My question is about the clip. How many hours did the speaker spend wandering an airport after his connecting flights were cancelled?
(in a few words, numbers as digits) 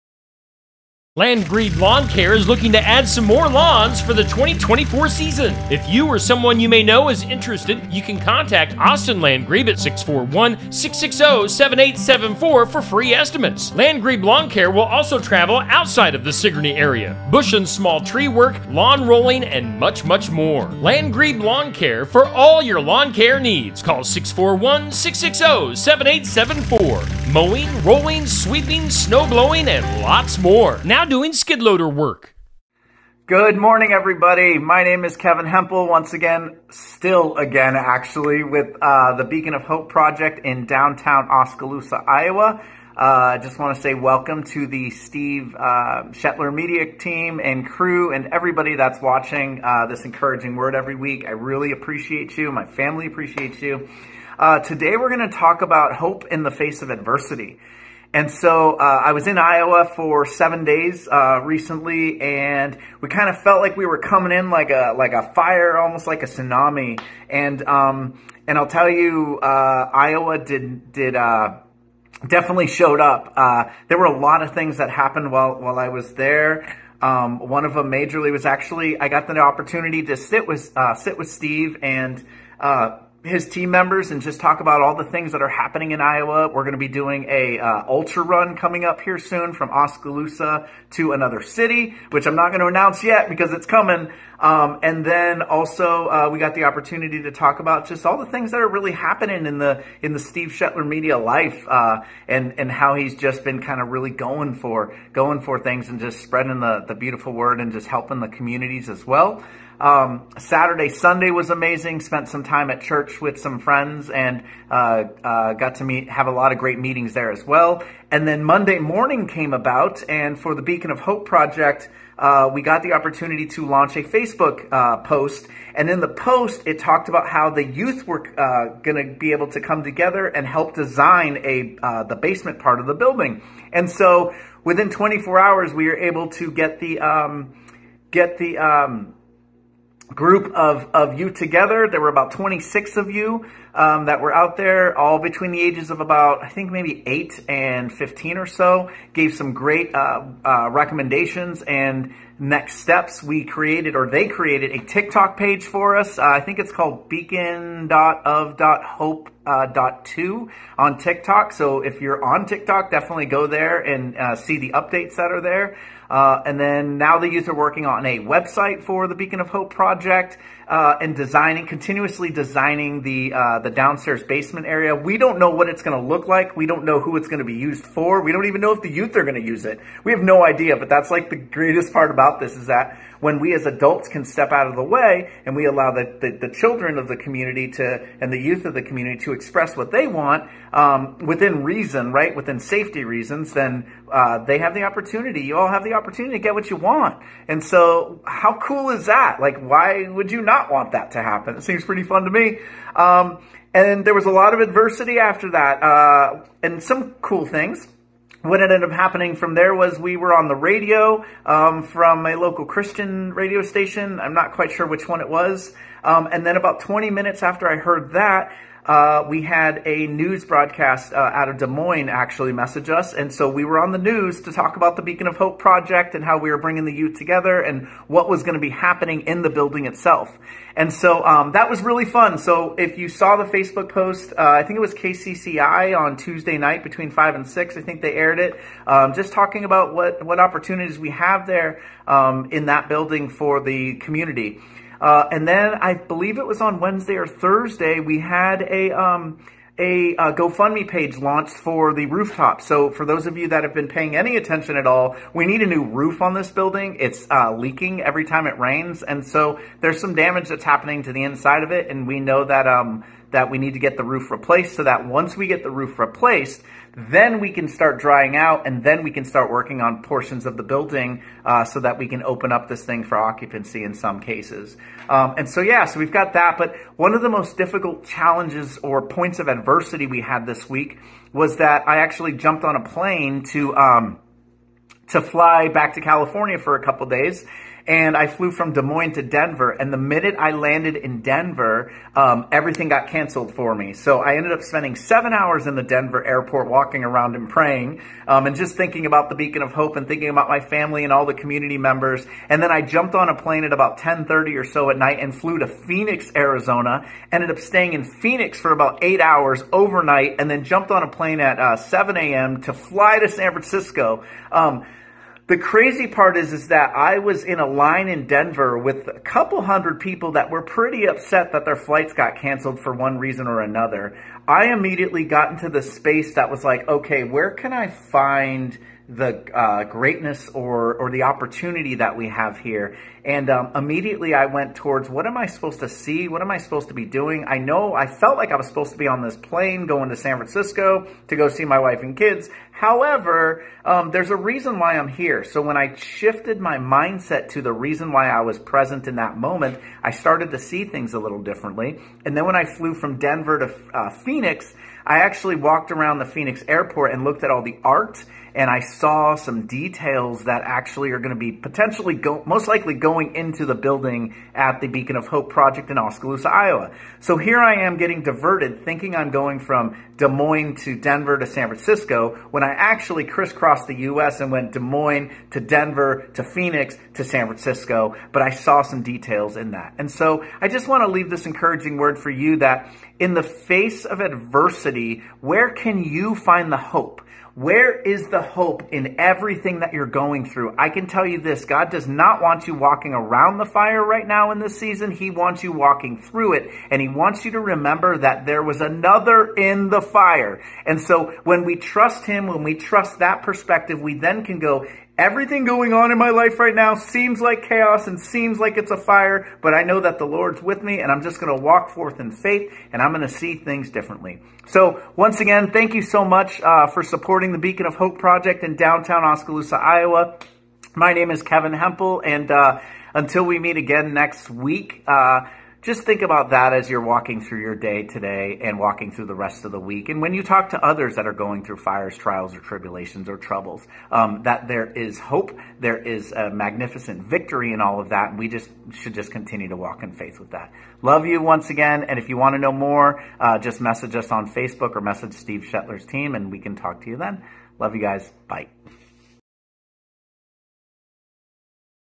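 7.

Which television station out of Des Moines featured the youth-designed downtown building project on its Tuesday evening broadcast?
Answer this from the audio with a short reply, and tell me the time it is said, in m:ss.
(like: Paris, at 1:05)
KCCI, at 3:54.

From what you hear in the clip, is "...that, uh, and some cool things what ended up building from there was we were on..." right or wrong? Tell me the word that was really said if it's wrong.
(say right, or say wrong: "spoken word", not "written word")
wrong: "happening", not "building".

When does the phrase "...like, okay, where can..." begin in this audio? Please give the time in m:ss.
5:26.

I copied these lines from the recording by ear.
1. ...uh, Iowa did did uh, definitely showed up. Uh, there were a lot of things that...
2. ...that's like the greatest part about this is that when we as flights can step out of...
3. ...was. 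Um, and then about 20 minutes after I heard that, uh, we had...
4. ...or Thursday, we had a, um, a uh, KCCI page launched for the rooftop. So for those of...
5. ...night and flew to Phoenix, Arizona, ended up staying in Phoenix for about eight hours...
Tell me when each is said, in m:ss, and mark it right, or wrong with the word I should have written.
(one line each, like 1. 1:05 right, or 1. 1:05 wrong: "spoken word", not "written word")
1. 1:09 right
2. 3:00 wrong: "adults", not "flights"
3. 3:35 right
4. 4:07 wrong: "GoFundMe", not "KCCI"
5. 5:04 right.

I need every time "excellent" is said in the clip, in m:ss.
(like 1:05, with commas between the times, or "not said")
not said.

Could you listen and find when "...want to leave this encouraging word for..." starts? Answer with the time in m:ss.
6:20.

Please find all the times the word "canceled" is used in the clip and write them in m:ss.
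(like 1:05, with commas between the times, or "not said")
4:53, 5:22.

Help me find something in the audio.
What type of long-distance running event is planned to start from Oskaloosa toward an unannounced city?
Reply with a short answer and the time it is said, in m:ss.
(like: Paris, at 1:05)
ultra run, at 1:27.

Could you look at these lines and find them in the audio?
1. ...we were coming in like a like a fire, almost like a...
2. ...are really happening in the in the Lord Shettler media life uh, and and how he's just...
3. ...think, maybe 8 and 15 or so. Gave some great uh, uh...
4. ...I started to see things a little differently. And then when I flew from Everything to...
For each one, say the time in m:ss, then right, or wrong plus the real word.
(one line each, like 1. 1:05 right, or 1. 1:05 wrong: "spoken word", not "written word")
1. 1:03 right
2. 1:38 wrong: "Steve", not "Lord"
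3. 2:26 right
4. 5:50 wrong: "Denver", not "Everything".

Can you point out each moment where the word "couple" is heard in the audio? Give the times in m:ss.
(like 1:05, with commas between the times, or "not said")
4:46, 5:19.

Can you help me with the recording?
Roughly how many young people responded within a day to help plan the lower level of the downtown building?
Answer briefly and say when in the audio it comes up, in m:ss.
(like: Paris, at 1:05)
26, at 2:22.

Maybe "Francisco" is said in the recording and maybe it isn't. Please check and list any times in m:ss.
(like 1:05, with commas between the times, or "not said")
5:13, 5:40, 6:11, 6:17.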